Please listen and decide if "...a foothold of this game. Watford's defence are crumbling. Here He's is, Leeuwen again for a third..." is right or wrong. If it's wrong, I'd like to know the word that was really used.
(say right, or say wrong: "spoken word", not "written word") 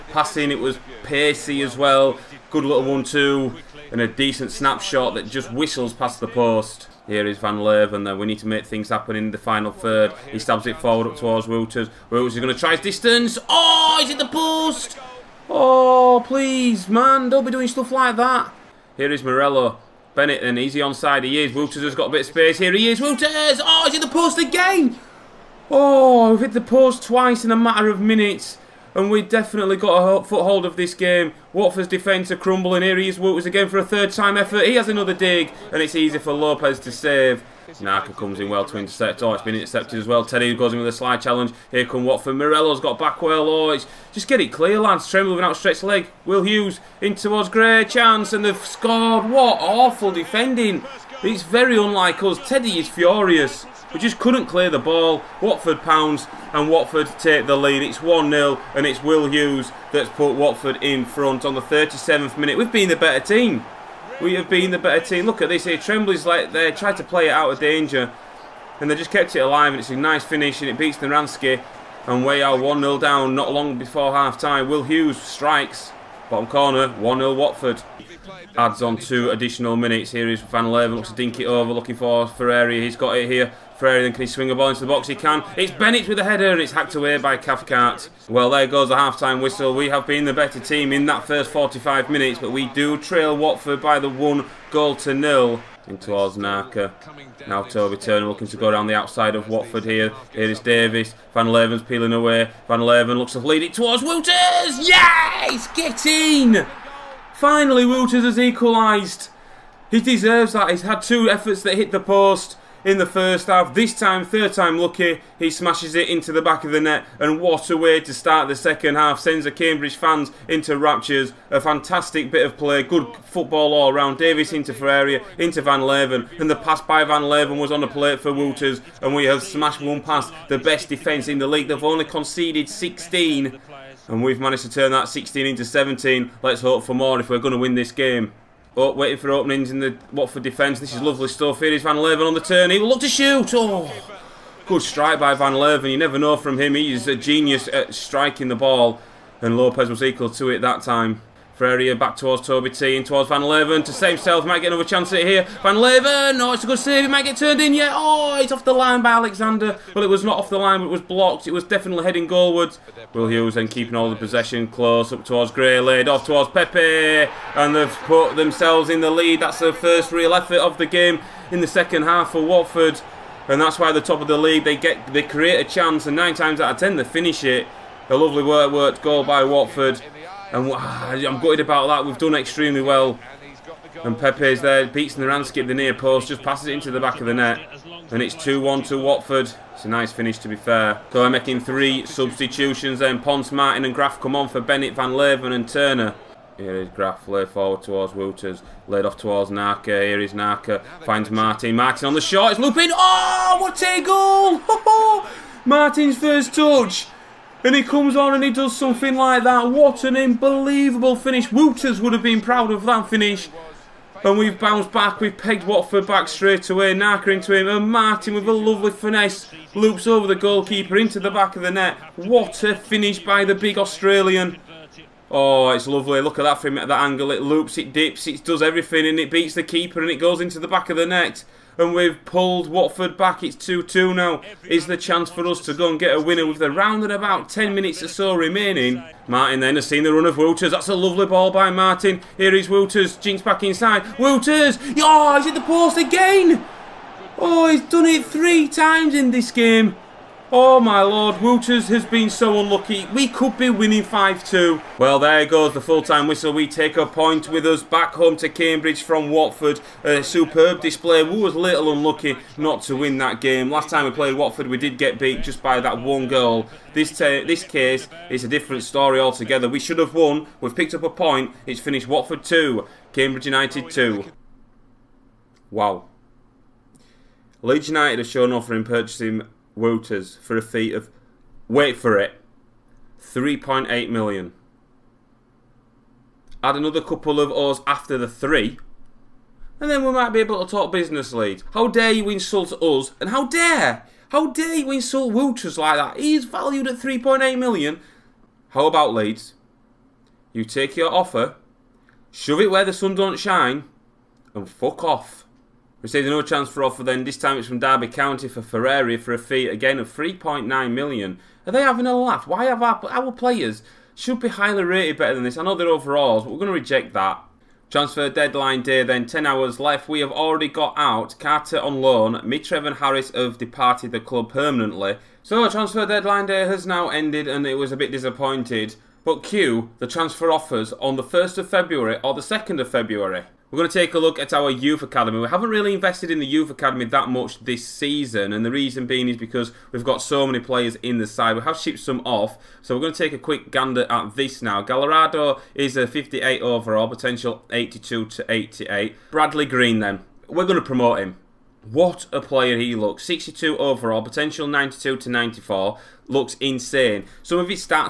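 wrong: "Wouters", not "Leeuwen".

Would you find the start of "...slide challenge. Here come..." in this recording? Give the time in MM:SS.
00:40.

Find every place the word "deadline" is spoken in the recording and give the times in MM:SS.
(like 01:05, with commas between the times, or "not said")
05:18, 05:26.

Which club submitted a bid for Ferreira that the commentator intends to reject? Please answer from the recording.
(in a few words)
Derby County.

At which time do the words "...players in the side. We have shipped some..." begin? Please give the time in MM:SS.
05:40.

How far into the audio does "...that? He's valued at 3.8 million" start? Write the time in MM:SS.
04:55.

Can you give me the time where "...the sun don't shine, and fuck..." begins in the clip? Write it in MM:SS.
05:02.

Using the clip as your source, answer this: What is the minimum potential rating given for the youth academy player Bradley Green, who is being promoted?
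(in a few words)
92.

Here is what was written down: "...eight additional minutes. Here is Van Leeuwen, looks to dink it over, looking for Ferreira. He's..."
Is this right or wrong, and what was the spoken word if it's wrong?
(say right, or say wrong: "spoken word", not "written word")
wrong: "two", not "eight".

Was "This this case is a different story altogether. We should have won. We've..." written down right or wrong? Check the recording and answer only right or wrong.
right.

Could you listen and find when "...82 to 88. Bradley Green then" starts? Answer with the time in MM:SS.
05:47.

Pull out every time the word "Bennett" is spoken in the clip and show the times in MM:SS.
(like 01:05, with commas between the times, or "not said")
00:20, 01:25, 03:14.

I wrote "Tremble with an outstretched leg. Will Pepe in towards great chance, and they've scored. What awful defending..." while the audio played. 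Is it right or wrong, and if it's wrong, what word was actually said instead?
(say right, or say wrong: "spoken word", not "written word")
wrong: "Hughes", not "Pepe".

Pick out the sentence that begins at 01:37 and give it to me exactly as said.
Now Toby Turner looking to go down the outside of Watford here.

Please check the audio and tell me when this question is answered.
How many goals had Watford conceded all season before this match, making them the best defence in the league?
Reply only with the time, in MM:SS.
02:11.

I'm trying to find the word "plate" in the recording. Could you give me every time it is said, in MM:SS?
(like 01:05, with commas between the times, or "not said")
02:07.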